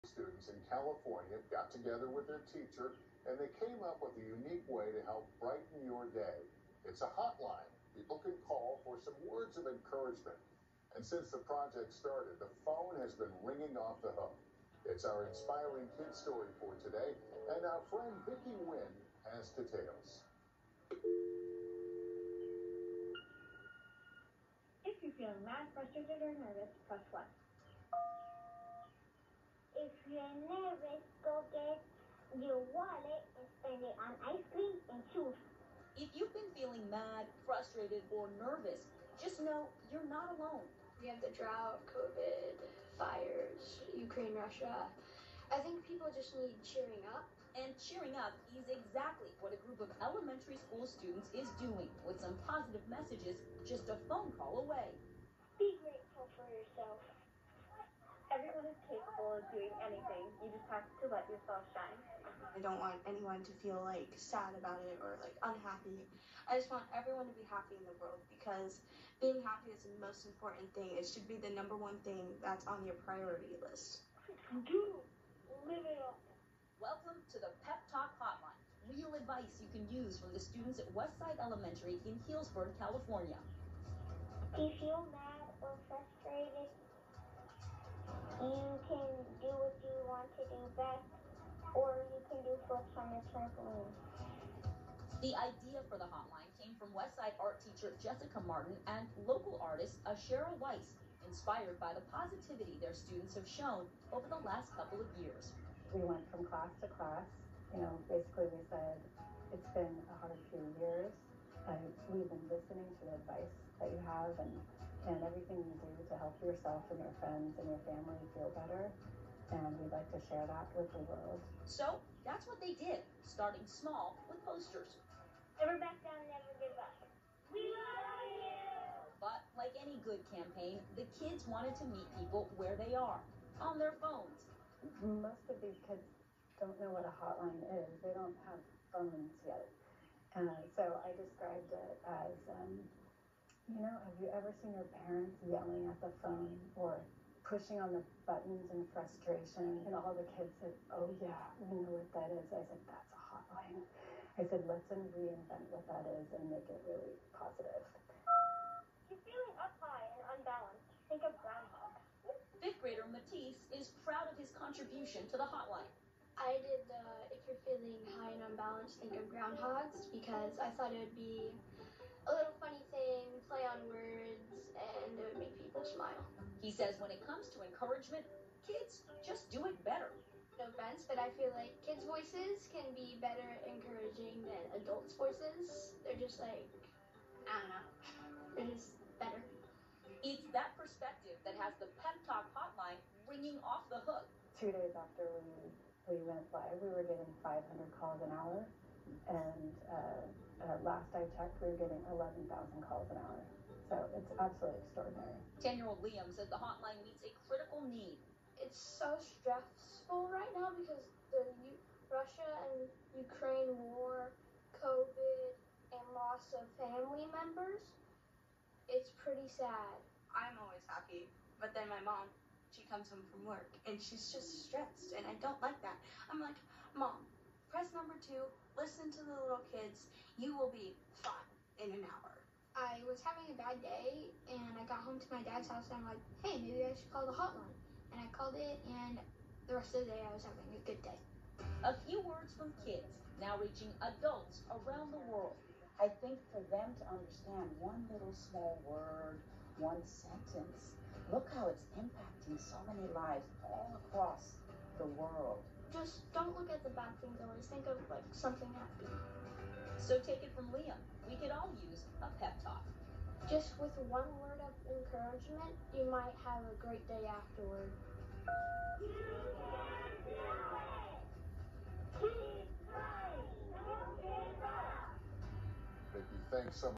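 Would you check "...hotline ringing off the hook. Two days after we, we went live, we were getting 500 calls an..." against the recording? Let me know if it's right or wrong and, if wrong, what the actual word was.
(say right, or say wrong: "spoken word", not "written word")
right.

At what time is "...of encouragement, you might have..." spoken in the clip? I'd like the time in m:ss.
4:24.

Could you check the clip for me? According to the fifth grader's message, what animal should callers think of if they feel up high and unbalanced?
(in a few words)
Groundhogs.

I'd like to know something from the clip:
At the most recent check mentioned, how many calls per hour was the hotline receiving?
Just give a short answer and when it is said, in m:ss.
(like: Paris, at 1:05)
11,000, at 3:22.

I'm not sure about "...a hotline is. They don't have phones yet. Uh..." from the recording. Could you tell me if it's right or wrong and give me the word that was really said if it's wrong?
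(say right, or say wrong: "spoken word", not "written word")
right.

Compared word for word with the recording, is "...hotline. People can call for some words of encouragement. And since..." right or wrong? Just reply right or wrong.
right.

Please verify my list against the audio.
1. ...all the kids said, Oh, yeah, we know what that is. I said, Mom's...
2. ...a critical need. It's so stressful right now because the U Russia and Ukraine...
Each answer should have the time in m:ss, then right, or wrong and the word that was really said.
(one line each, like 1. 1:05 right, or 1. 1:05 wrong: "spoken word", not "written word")
1. 2:29 wrong: "That", not "Mom"
2. 3:27 right.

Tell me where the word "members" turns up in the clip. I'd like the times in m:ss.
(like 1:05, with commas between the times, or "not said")
3:37.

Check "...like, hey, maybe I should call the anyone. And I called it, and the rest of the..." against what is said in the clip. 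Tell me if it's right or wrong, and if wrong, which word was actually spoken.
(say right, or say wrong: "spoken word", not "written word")
wrong: "hotline", not "anyone".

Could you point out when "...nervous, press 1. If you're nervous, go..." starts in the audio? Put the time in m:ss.
0:26.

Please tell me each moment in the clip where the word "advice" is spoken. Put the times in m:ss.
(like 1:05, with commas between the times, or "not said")
1:19, 1:53.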